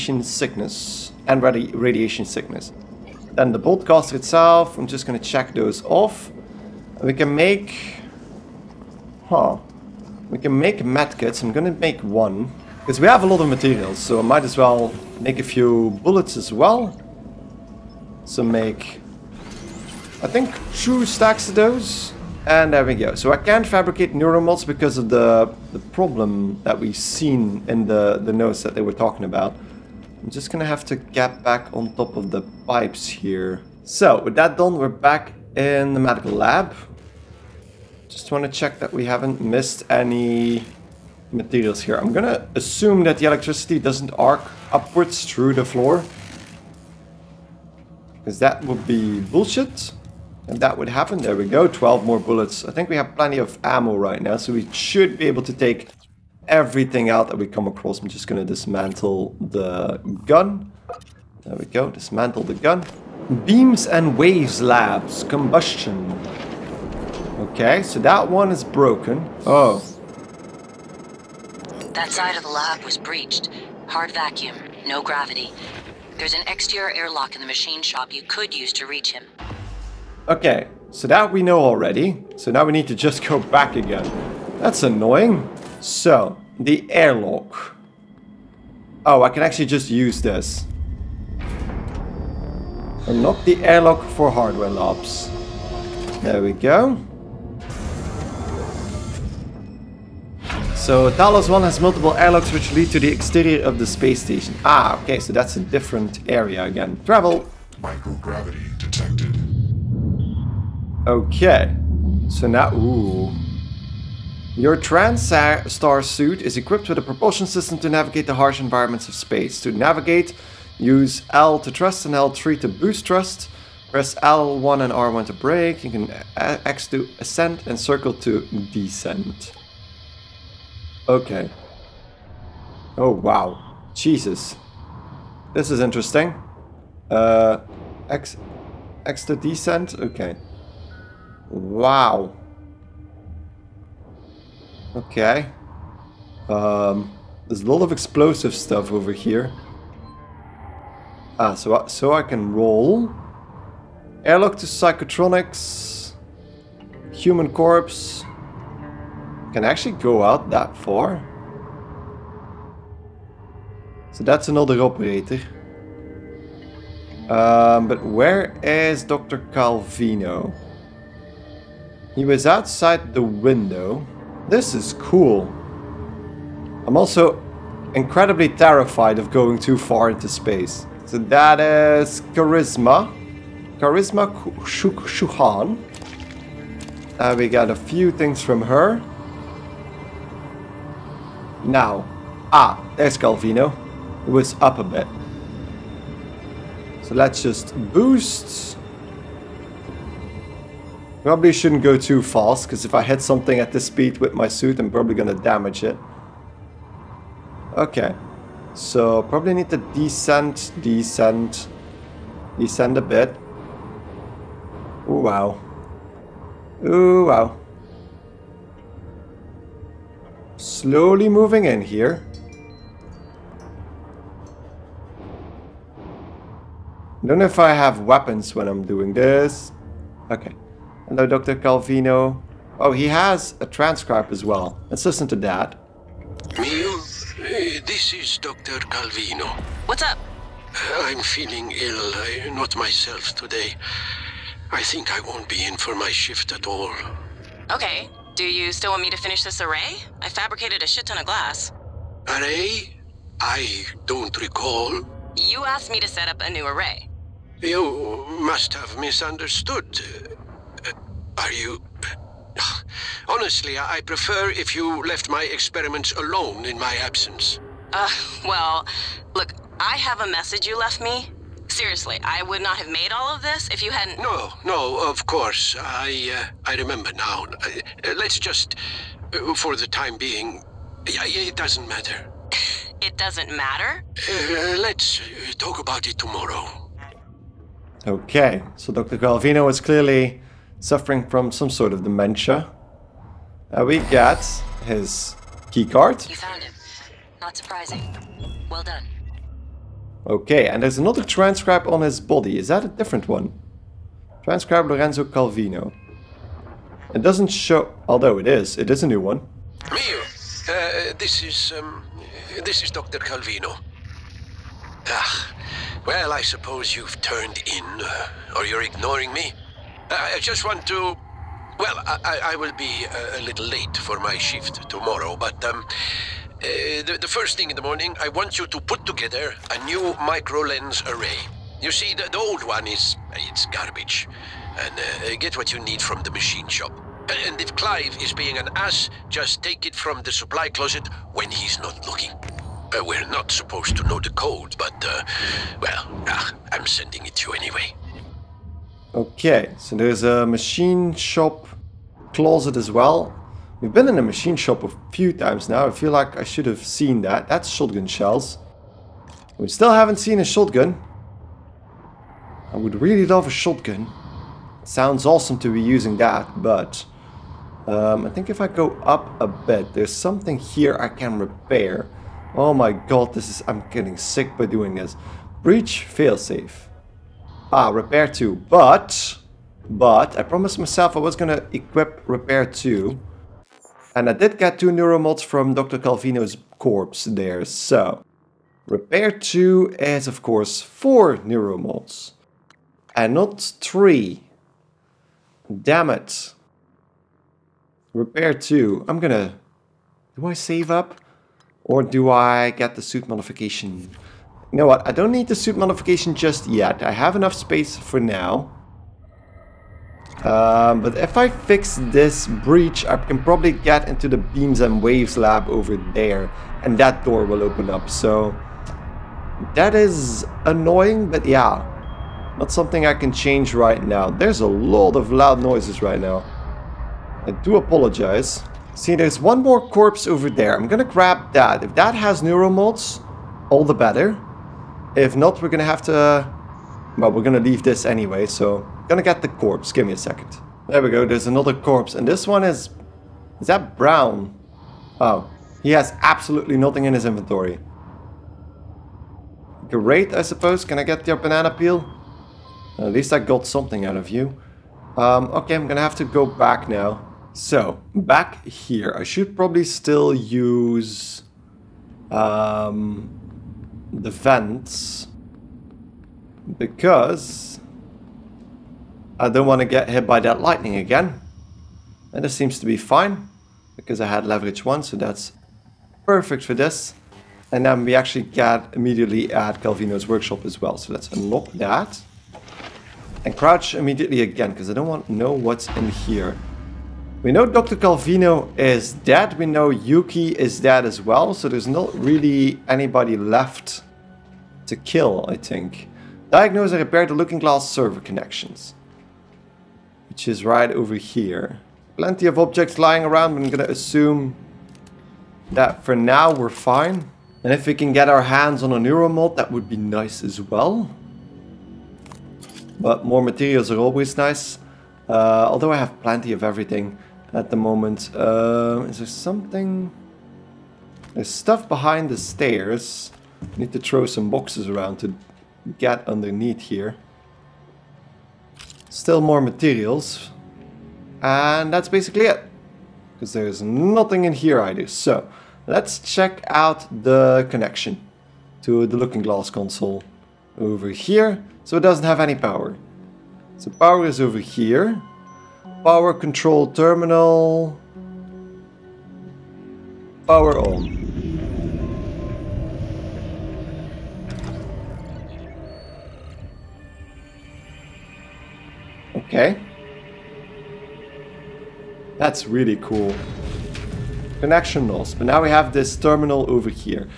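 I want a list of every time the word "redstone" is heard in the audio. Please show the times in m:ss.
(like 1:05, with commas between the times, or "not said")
not said.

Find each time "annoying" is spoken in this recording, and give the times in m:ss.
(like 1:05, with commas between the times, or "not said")
1:24, 7:00.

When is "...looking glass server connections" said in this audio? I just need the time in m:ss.
8:17.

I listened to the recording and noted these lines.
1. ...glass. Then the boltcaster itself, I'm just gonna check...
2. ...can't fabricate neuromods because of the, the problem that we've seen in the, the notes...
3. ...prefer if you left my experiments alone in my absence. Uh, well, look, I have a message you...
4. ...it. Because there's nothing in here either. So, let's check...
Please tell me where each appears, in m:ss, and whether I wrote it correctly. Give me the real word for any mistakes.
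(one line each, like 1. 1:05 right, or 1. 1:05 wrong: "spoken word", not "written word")
1. 0:02 wrong: "sickness", not "glass"
2. 0:23 right
3. 4:24 right
4. 8:52 right.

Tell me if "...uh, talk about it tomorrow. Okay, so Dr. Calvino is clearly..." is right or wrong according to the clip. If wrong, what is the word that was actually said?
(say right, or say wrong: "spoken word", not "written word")
right.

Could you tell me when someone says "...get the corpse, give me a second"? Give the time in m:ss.
7:19.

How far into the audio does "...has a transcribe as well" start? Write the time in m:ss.
3:53.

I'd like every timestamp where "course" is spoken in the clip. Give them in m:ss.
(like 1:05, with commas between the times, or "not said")
4:35, 6:30.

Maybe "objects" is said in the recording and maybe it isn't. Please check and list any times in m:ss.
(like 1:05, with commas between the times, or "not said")
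8:22.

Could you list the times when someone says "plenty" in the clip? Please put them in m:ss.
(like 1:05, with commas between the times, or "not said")
0:53, 8:22, 8:36.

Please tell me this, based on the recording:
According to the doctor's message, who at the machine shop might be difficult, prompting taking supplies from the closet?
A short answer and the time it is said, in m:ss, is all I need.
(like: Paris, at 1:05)
Clive, at 5:37.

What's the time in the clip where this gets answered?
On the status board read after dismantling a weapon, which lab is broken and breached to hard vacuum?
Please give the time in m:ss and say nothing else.
1:03.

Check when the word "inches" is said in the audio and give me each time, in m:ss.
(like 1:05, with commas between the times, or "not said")
not said.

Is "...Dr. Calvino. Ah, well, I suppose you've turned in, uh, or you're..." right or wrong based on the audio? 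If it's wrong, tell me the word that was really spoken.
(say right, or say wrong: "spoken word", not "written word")
right.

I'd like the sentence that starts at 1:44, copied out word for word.
Ah, okay, so that's a different area again.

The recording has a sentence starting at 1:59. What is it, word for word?
To navigate, use L to thrust and L3 to boost thrust.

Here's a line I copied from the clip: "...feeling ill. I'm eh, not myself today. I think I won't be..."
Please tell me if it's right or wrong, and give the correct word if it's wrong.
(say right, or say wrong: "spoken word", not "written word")
right.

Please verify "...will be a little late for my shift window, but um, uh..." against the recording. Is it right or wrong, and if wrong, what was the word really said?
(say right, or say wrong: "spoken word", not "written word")
wrong: "tomorrow", not "window".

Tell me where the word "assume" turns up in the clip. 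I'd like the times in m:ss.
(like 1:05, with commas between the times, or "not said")
0:42, 8:23.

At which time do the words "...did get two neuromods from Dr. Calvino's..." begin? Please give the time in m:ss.
6:24.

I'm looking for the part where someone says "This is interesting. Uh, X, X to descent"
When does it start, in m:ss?
2:15.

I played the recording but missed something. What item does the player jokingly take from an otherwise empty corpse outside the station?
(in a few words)
Banana peel.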